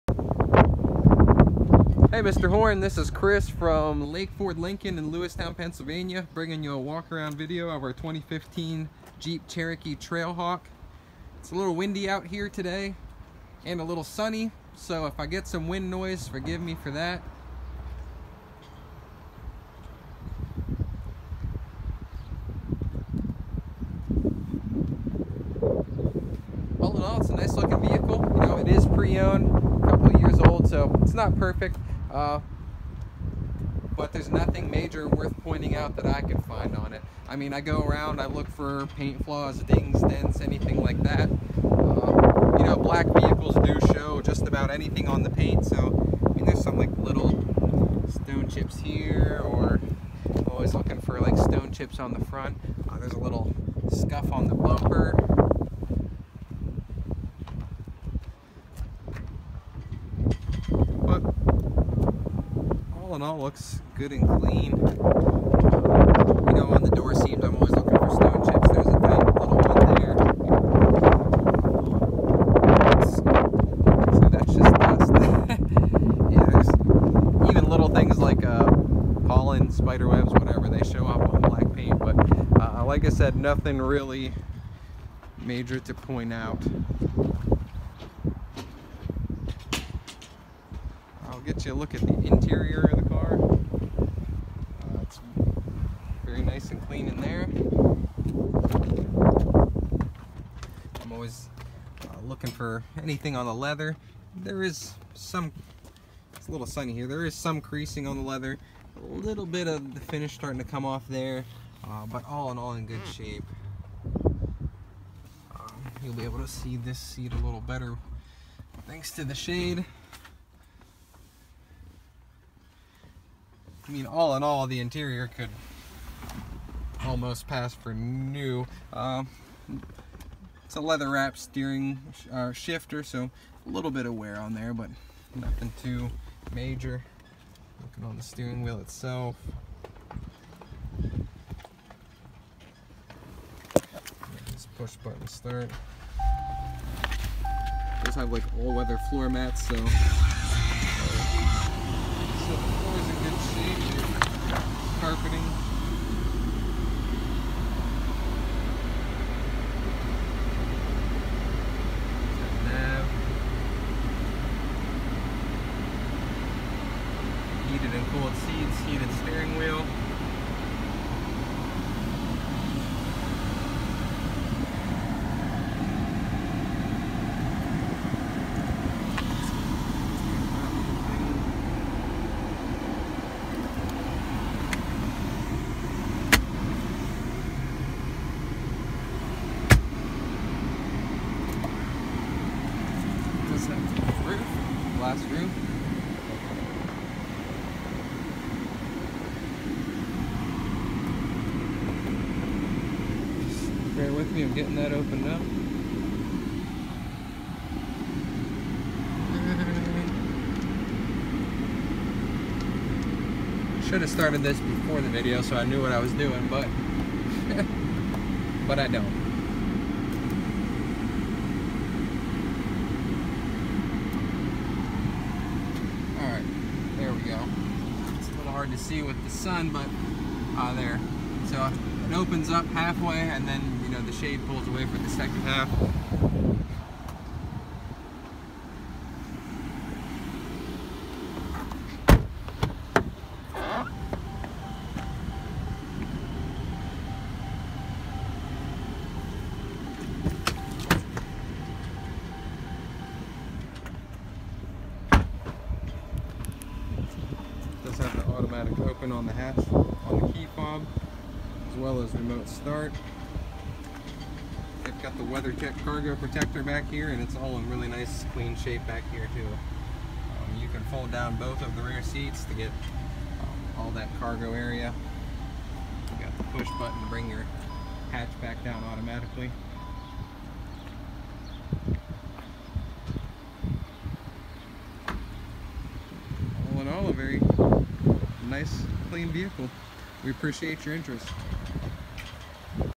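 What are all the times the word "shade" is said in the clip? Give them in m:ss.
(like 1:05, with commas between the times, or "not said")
1:59, 3:54.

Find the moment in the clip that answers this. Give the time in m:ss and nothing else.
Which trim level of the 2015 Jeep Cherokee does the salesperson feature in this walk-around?
0:09.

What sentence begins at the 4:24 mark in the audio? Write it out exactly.
I've got the WeatherTech cargo protector back here, and it's all in really nice, clean shape back here too.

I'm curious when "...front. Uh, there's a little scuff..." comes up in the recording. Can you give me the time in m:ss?
0:52.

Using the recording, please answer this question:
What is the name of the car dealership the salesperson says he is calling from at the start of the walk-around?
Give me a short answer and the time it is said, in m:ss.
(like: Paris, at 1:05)
Lake Ford Lincoln, at 0:04.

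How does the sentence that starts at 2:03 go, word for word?
I mean, all in all, the interior could almost pass for new.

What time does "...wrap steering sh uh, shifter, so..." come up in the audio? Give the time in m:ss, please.
2:11.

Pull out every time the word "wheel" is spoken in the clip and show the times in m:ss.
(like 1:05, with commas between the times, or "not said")
2:18, 2:49.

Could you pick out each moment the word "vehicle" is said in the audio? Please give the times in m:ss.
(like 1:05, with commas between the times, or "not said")
0:27, 0:43, 4:49.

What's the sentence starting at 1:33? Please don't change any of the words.
Uh, it's very nice and clean in there.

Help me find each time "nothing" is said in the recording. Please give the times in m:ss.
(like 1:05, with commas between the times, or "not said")
0:34, 1:23, 2:15.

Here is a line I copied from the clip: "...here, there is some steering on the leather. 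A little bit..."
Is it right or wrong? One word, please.
wrong.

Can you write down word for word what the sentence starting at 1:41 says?
I'm always uh, looking for anything on the leather.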